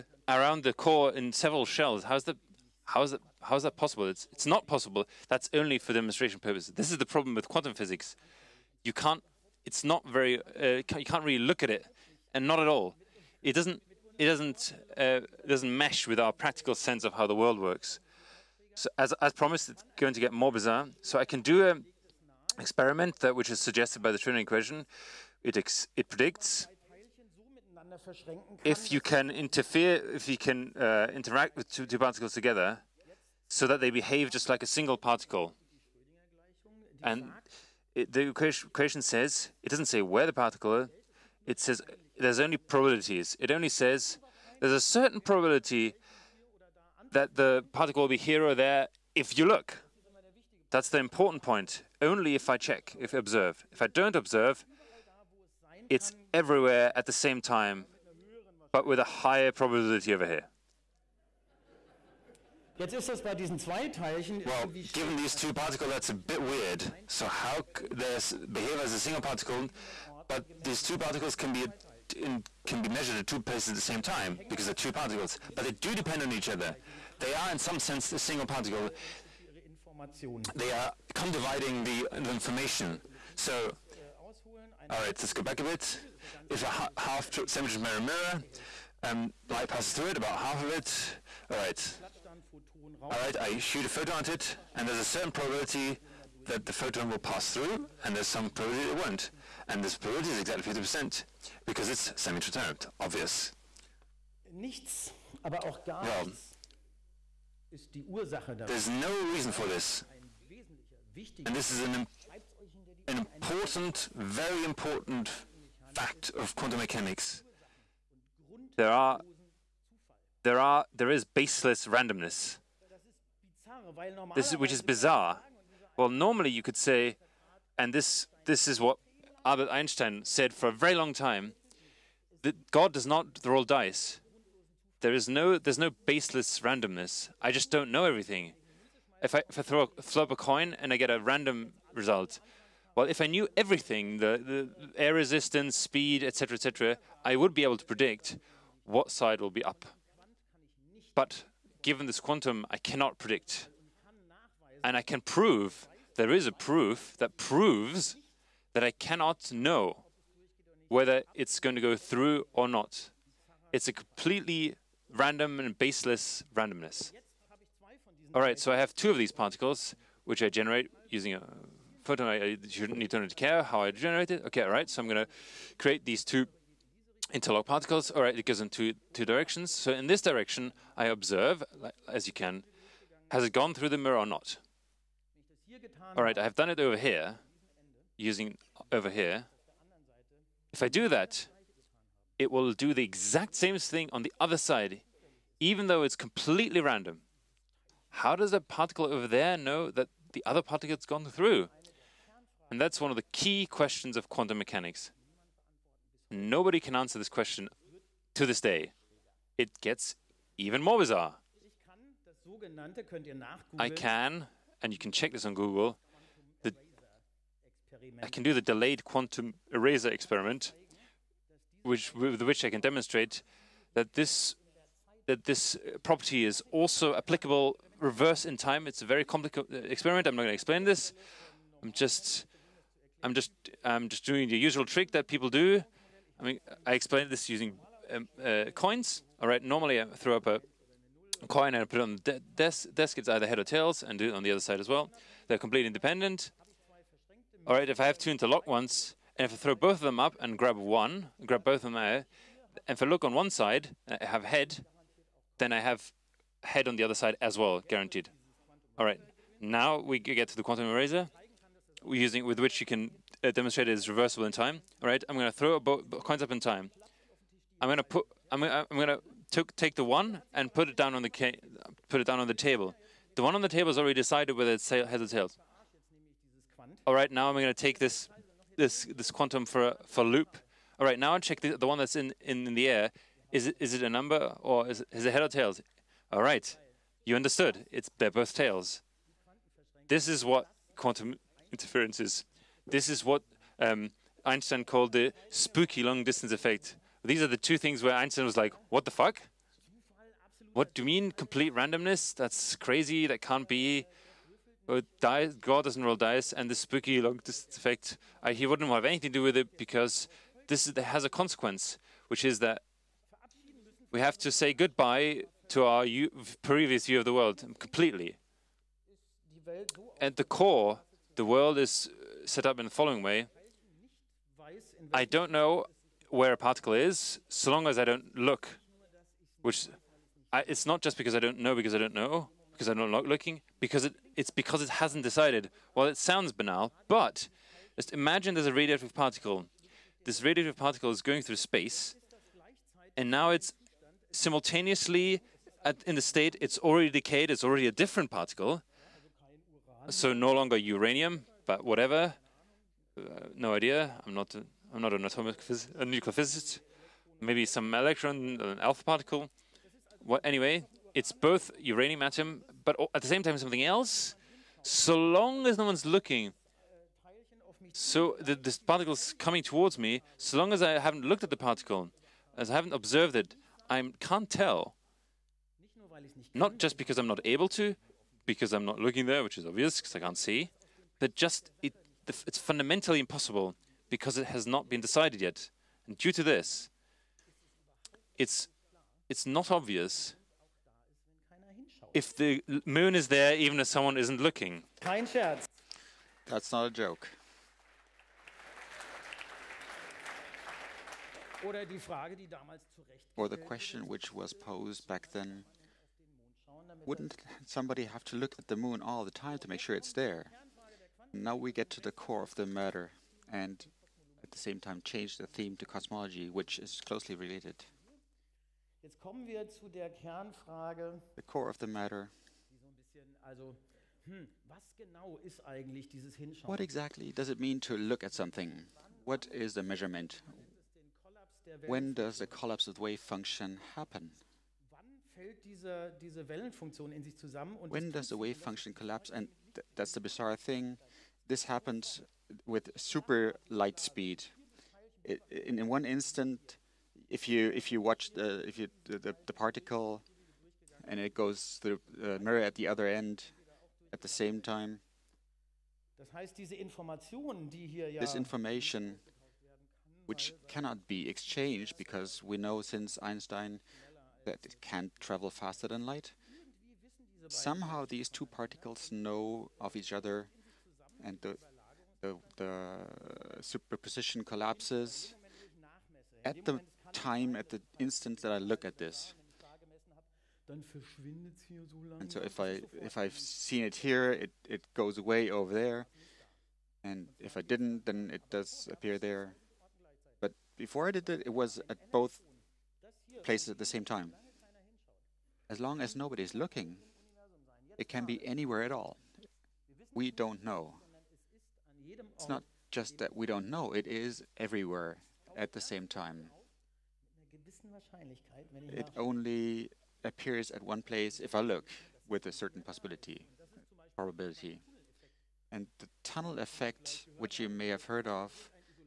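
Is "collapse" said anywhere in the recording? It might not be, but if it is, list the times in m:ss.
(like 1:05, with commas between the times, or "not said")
7:12, 7:18, 7:54.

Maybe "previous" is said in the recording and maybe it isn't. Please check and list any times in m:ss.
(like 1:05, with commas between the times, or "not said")
5:16.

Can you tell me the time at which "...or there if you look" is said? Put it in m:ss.
0:48.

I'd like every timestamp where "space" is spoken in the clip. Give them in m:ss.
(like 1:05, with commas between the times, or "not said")
5:41.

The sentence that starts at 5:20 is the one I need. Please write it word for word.
At the core, the world is uh, set up in the following way.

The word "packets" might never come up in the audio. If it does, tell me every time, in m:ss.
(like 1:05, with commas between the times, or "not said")
not said.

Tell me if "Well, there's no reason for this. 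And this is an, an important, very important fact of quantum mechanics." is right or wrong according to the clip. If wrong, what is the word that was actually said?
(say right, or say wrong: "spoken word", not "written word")
right.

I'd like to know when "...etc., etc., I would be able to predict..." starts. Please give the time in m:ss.
2:26.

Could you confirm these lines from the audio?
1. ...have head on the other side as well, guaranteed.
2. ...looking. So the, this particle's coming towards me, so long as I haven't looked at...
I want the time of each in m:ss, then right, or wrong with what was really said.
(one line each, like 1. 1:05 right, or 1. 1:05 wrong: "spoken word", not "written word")
1. 4:15 right
2. 6:06 right.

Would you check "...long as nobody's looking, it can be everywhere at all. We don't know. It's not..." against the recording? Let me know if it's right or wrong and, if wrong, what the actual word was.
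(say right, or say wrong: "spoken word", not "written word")
wrong: "anywhere", not "everywhere".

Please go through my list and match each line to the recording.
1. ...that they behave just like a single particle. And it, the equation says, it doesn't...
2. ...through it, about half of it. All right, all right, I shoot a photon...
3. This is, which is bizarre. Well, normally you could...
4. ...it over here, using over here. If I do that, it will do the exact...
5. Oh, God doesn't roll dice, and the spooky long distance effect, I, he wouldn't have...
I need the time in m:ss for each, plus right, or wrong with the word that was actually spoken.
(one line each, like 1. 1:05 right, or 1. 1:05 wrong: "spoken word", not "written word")
1. 0:33 right
2. 1:29 right
3. 2:04 right
4. 3:06 right
5. 5:04 right.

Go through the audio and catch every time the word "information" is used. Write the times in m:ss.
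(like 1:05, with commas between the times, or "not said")
1:22, 7:38.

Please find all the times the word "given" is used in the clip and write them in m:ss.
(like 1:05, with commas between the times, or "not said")
1:04, 2:31.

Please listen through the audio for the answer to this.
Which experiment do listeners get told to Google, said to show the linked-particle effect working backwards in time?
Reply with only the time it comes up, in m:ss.
3:38.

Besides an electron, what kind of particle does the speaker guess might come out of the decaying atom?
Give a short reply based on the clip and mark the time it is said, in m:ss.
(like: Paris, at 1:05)
an alpha particle, at 5:58.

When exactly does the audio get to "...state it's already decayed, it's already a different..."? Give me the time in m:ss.
5:46.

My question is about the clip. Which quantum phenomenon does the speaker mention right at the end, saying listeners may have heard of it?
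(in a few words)
tunnel effect.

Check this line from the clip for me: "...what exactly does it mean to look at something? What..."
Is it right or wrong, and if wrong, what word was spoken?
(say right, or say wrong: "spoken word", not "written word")
right.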